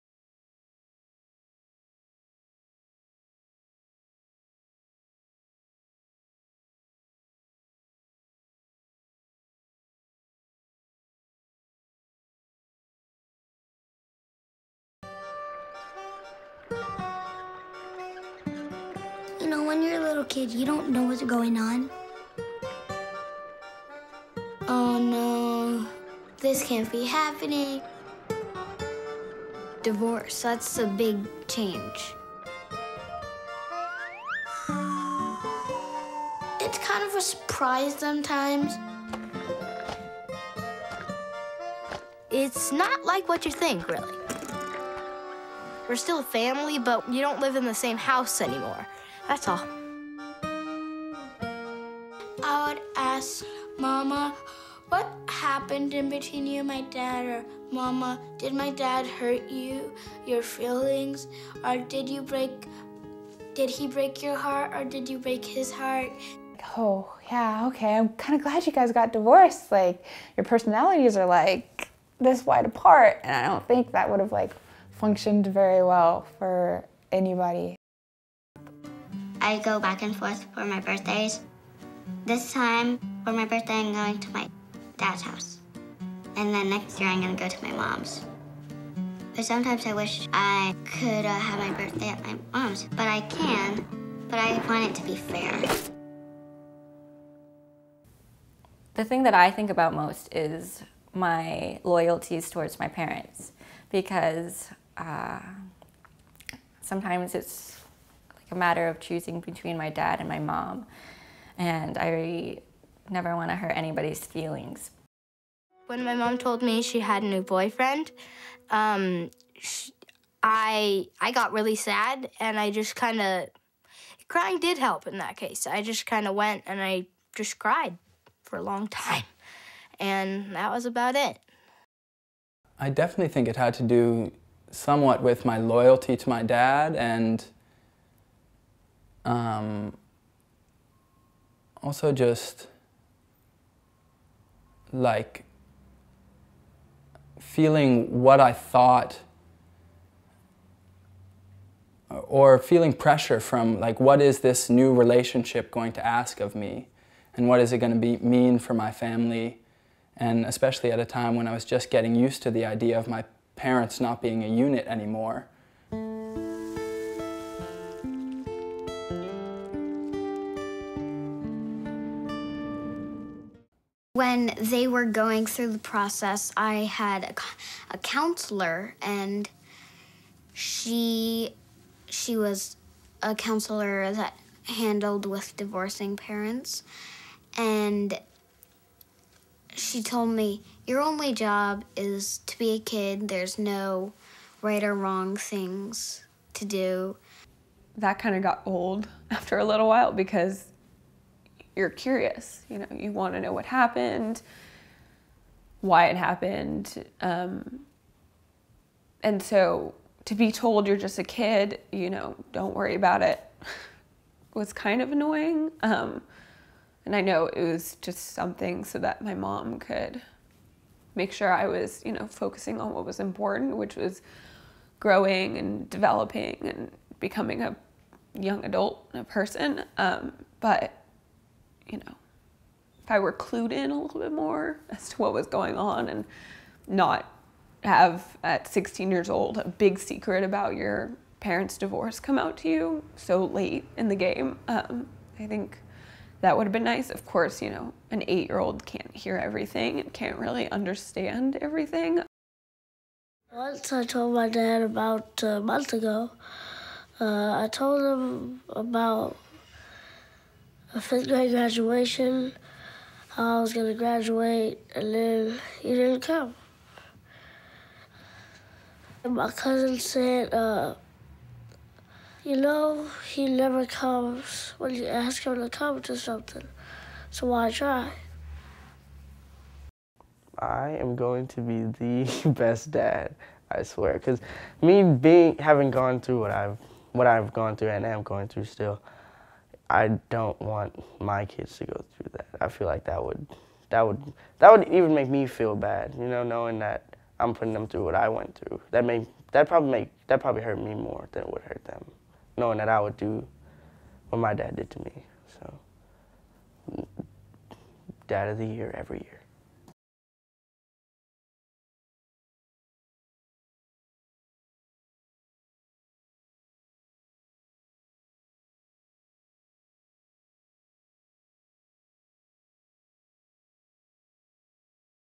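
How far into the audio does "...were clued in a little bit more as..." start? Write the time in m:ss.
3:53.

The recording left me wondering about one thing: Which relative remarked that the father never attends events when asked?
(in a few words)
Cousin.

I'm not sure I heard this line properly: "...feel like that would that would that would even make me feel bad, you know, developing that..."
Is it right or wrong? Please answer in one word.
wrong.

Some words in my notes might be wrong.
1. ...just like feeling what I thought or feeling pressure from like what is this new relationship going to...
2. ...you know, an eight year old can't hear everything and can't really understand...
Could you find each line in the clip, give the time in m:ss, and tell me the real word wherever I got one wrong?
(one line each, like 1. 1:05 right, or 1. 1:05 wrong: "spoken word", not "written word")
1. 2:22 right
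2. 4:07 right.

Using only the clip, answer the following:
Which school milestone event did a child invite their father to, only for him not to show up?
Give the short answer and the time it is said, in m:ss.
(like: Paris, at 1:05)
Fifth grade graduation, at 4:21.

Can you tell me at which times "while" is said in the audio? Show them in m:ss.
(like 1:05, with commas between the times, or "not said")
3:19.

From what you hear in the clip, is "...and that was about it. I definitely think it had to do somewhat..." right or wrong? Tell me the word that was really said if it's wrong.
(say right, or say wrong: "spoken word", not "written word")
right.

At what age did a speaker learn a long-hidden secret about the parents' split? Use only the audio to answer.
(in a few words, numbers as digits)
16.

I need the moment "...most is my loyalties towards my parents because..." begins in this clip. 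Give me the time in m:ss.
1:39.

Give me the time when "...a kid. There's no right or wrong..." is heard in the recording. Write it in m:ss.
3:12.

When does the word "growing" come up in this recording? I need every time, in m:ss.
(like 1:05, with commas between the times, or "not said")
3:44.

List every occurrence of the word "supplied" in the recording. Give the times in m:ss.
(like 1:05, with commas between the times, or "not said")
not said.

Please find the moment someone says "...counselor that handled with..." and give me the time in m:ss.
3:03.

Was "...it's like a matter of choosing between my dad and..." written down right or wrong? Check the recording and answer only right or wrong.
right.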